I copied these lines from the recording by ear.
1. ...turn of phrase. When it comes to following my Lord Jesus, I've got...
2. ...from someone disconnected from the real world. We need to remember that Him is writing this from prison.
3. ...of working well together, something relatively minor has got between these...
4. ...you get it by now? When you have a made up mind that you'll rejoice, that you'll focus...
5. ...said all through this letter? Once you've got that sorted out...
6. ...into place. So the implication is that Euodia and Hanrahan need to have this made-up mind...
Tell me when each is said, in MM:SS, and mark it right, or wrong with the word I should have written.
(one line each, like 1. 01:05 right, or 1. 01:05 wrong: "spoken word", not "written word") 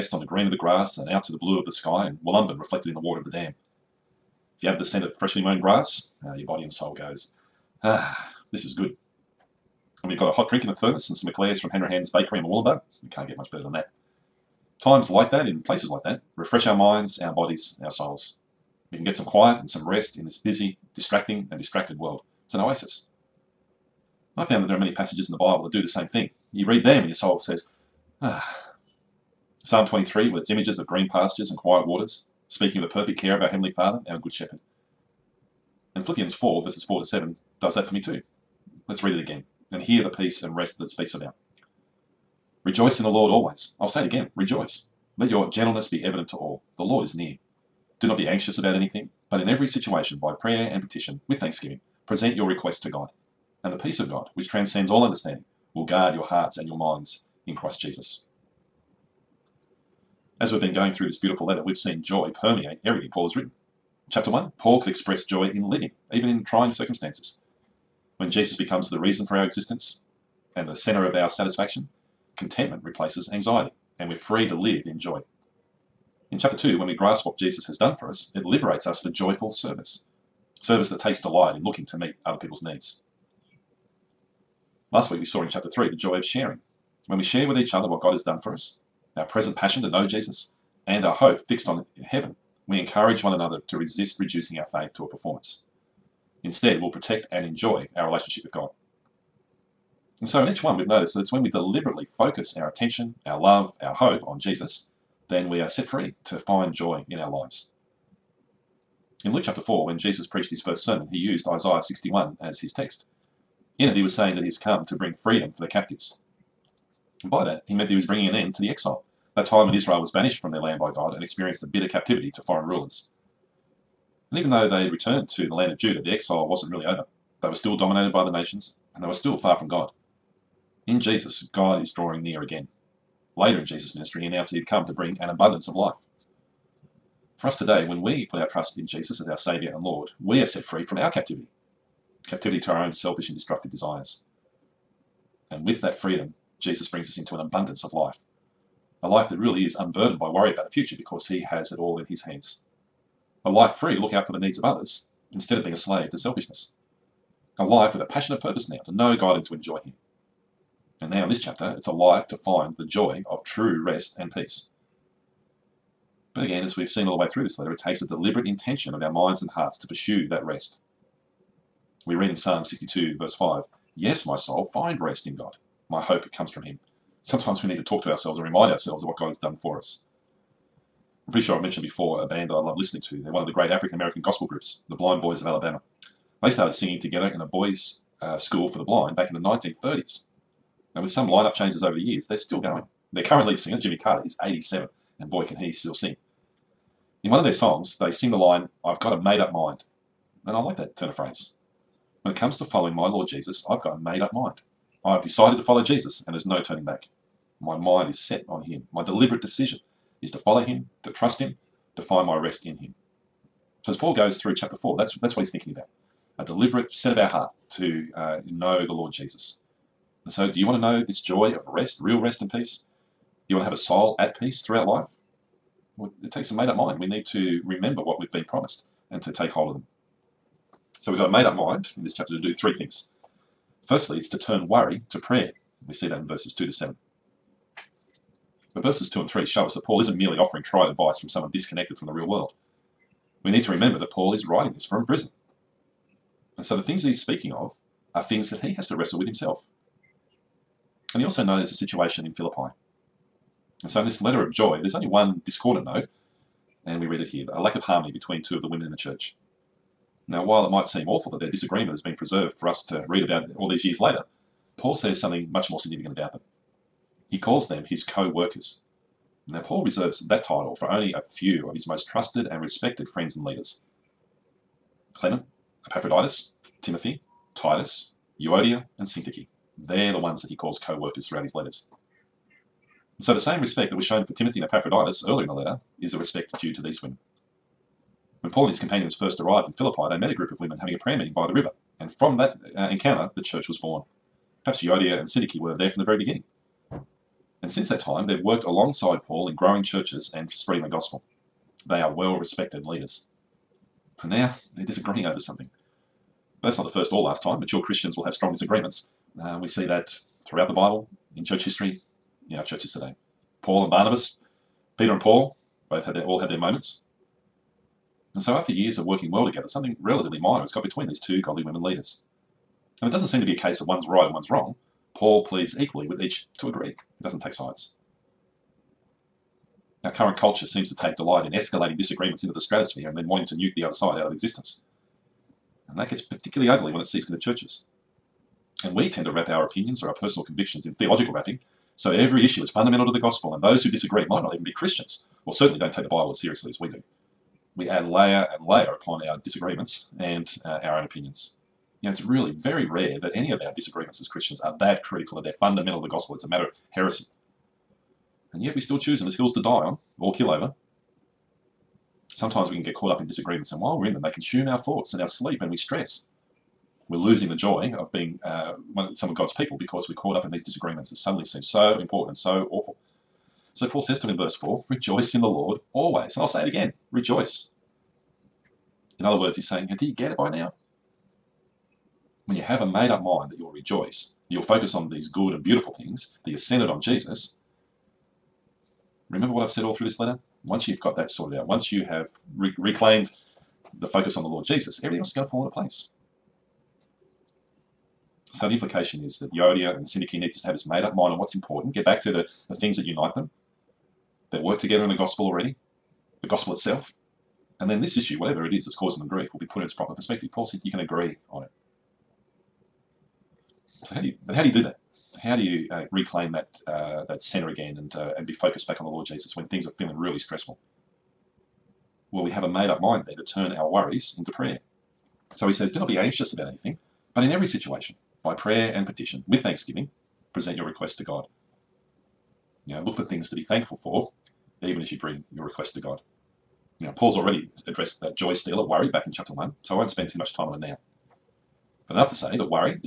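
1. 03:20 right
2. 04:01 wrong: "Paul", not "Him"
3. 05:18 right
4. 06:20 right
5. 06:29 right
6. 06:35 wrong: "Syntyche", not "Hanrahan".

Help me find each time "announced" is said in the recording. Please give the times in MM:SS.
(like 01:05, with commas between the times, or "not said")
02:14.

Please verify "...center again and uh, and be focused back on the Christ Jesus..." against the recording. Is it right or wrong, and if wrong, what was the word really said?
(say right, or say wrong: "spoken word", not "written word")
wrong: "Lord", not "Christ".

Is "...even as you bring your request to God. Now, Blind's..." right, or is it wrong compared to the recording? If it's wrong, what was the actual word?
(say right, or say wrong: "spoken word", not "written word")
wrong: "Paul", not "Blind".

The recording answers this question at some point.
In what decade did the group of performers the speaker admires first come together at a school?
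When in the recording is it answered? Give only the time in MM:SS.
03:09.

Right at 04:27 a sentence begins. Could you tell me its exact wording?
He calls them his co workers.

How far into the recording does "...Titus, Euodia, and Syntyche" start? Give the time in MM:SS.
04:37.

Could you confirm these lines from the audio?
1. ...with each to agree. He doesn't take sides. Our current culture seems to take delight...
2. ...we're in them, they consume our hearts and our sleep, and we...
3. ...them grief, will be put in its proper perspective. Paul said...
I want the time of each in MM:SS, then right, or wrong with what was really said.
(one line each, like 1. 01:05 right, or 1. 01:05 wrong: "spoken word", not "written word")
1. 05:26 right
2. 06:03 wrong: "thoughts", not "hearts"
3. 06:49 right.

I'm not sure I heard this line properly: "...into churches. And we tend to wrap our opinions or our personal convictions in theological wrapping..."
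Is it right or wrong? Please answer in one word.
right.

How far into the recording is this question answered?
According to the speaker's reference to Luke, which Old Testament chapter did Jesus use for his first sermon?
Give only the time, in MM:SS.
01:51.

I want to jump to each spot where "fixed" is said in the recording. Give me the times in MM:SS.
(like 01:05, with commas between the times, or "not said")
01:31.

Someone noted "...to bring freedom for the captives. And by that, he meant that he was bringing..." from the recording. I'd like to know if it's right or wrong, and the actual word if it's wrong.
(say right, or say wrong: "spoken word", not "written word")
right.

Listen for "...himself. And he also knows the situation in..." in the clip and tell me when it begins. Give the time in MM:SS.
04:09.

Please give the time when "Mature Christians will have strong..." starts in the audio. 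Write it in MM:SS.
05:07.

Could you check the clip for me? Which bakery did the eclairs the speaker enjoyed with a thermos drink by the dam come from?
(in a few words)
Hanrahan's Bakery.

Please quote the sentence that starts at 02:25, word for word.
And with that freedom, Jesus brings us into an abundance of life.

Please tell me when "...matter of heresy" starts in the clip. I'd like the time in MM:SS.
05:56.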